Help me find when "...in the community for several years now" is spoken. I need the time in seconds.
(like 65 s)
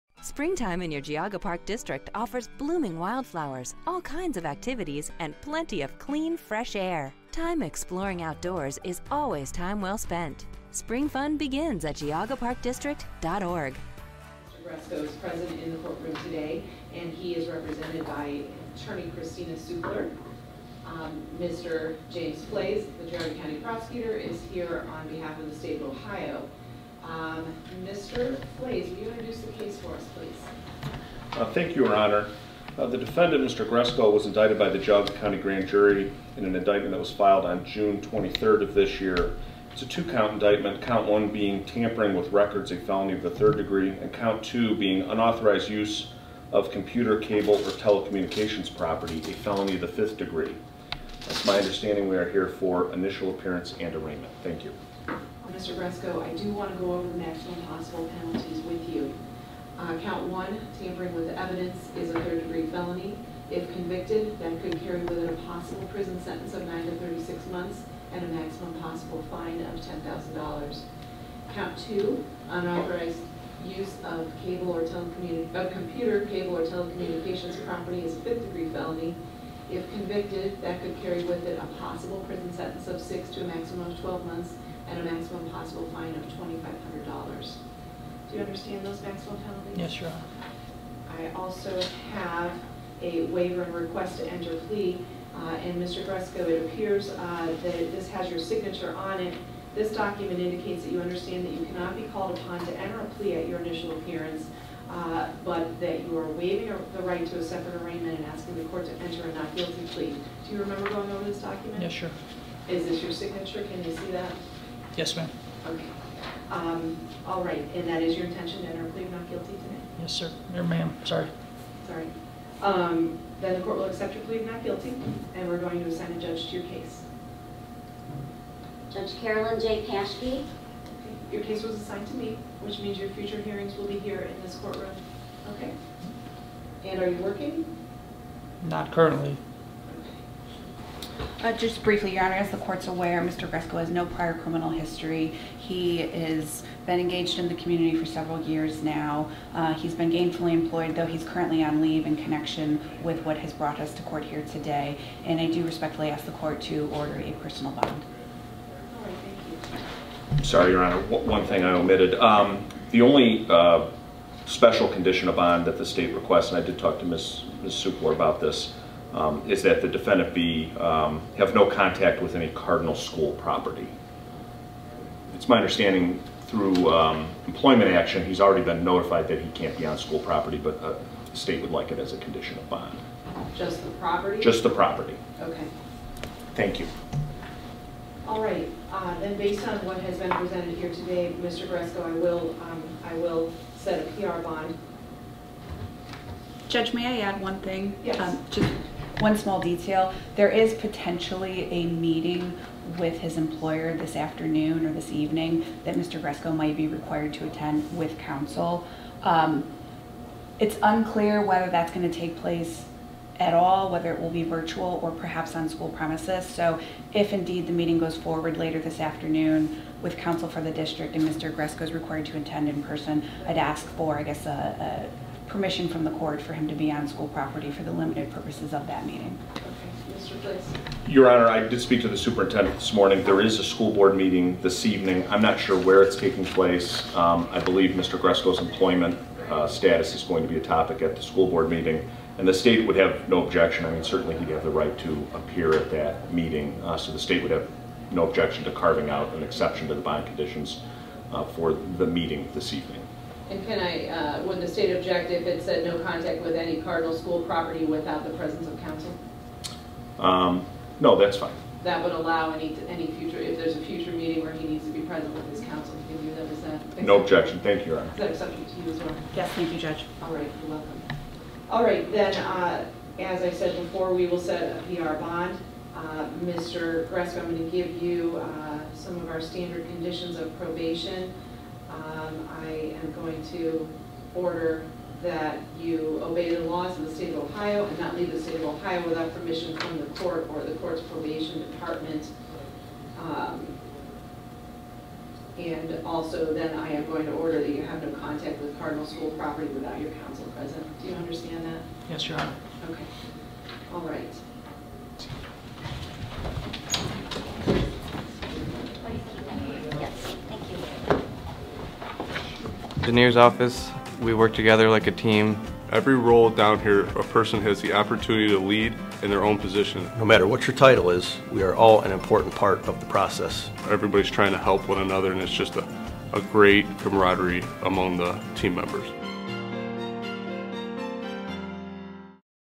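147 s.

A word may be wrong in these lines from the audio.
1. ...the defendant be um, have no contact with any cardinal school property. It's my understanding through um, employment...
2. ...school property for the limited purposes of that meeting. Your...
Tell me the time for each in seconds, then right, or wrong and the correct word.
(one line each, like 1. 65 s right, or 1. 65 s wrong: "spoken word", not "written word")
1. 169 s right
2. 227 s right.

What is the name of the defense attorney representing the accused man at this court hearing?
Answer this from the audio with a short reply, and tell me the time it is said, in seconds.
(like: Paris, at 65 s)
Christina Supler, at 19 s.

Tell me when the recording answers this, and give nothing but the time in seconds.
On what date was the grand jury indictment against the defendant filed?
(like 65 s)
37 s.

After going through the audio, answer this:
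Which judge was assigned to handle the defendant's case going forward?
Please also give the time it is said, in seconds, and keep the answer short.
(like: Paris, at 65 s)
Carolyn J. Paschke, at 129 s.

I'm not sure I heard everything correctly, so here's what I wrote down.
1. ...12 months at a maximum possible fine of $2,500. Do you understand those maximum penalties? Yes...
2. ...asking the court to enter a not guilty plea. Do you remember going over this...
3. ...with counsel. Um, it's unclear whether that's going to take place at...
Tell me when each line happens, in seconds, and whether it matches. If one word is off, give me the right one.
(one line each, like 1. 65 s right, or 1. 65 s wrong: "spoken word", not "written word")
1. 83 s right
2. 108 s right
3. 207 s right.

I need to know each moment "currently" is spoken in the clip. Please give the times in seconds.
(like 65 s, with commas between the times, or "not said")
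138 s, 151 s.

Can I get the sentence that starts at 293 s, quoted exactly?
Um, and also then I am going to order that you have no contact with Cardinal School property without your counsel present.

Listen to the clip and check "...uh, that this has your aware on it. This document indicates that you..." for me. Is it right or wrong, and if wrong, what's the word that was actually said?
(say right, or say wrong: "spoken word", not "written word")
wrong: "signature", not "aware".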